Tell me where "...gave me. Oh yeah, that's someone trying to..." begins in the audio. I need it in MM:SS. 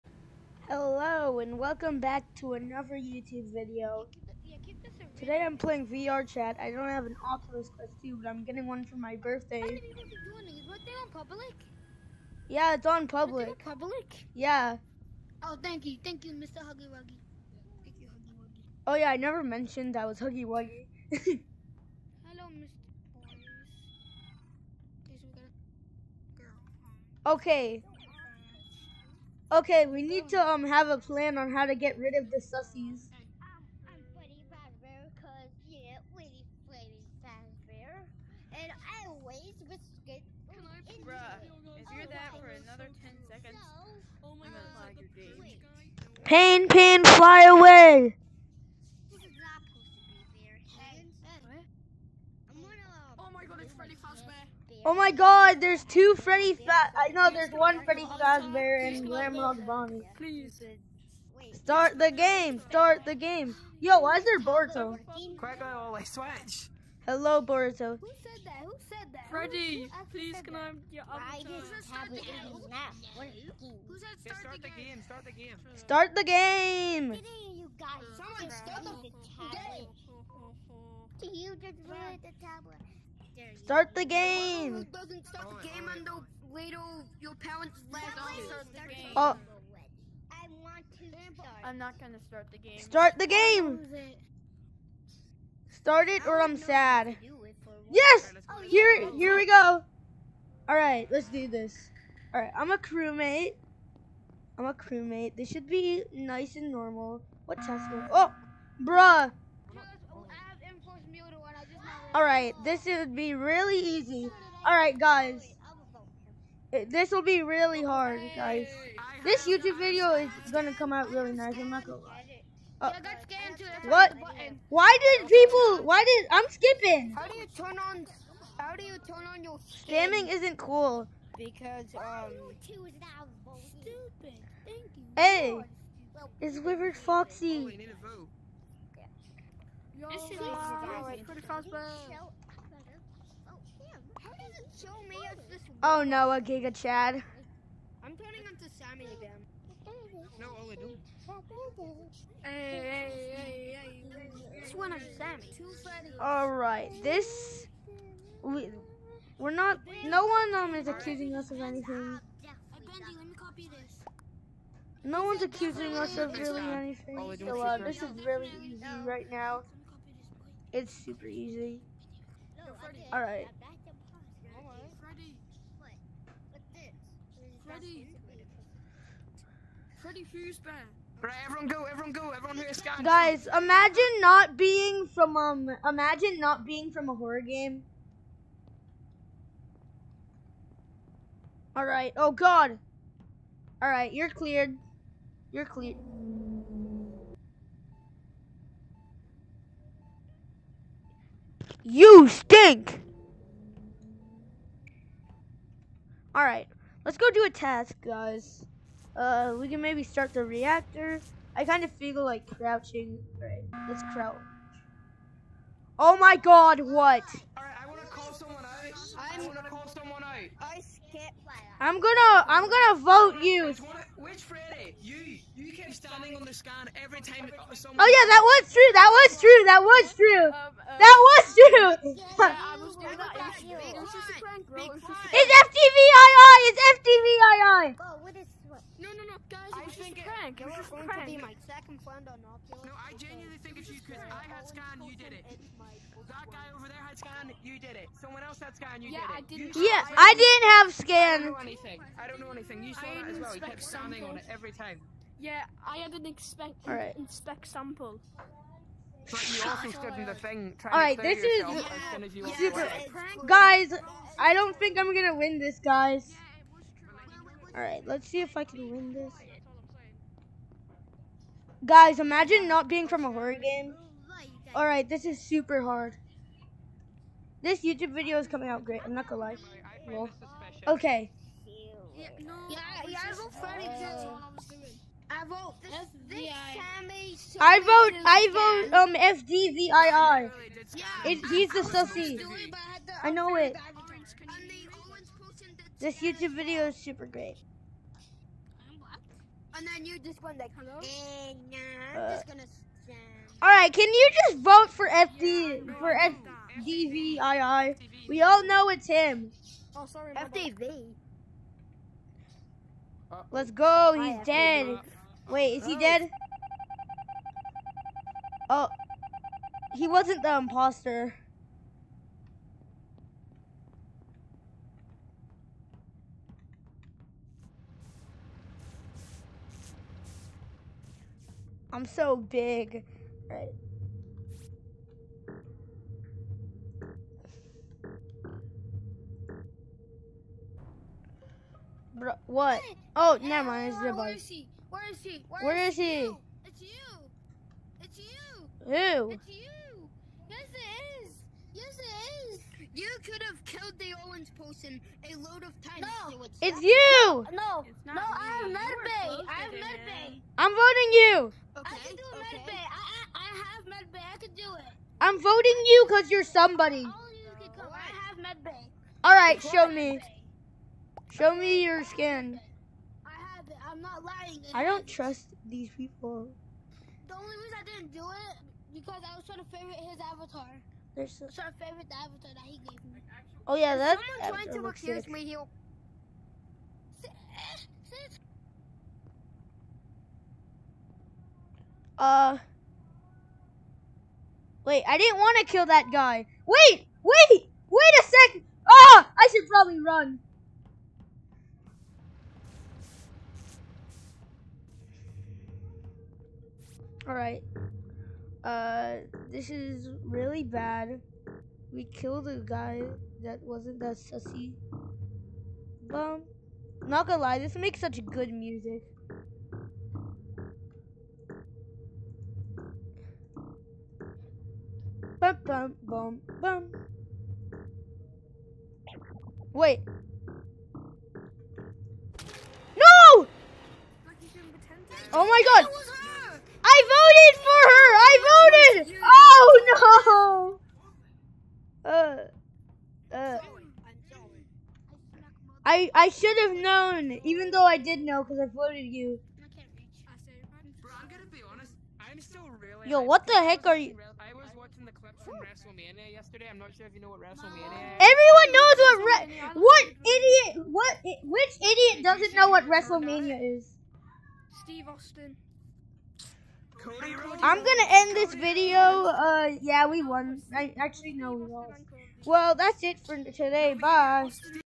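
06:22.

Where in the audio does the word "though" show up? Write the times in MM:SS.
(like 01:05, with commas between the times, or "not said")
07:27.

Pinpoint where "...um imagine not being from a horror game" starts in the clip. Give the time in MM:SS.
03:05.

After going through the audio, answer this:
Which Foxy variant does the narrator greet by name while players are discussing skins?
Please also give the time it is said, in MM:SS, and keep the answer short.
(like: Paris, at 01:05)
Wizard Foxy, at 02:16.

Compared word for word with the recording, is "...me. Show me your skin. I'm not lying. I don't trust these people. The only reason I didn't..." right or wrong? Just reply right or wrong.
right.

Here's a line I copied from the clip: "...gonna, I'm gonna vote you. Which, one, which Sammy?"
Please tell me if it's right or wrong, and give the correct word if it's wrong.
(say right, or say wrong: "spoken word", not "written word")
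wrong: "Freddy", not "Sammy".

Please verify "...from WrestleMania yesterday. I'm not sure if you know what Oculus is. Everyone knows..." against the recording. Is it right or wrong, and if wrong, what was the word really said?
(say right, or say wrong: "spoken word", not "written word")
wrong: "WrestleMania", not "Oculus".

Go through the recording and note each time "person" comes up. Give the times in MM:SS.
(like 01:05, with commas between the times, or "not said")
05:54.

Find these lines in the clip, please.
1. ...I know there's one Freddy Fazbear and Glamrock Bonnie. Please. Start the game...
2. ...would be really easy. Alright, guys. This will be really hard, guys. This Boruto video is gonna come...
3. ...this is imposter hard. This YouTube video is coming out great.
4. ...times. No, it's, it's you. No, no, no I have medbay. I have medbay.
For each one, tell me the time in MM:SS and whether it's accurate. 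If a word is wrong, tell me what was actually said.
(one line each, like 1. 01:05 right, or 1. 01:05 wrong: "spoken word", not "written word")
1. 00:56 right
2. 01:52 wrong: "YouTube", not "Boruto"
3. 04:35 wrong: "super", not "imposter"
4. 05:55 right.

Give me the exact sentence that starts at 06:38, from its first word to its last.
Ah, oh, I should probably run.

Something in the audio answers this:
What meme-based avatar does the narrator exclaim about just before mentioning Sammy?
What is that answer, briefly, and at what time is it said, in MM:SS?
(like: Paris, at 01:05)
Giga Chad, at 02:26.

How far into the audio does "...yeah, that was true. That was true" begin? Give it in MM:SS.
03:48.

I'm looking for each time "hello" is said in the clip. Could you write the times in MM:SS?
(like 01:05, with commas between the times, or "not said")
00:00, 00:22, 01:07, 05:00.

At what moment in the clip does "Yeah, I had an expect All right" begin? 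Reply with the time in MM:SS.
04:15.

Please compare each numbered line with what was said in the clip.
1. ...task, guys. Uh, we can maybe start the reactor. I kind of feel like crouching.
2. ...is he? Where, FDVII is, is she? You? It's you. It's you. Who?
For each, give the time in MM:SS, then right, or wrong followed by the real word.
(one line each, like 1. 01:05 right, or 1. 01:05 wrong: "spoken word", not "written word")
1. 03:27 right
2. 05:45 wrong: "Where", not "FDVII".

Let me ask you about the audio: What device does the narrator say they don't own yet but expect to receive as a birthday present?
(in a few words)
Oculus Quest 2.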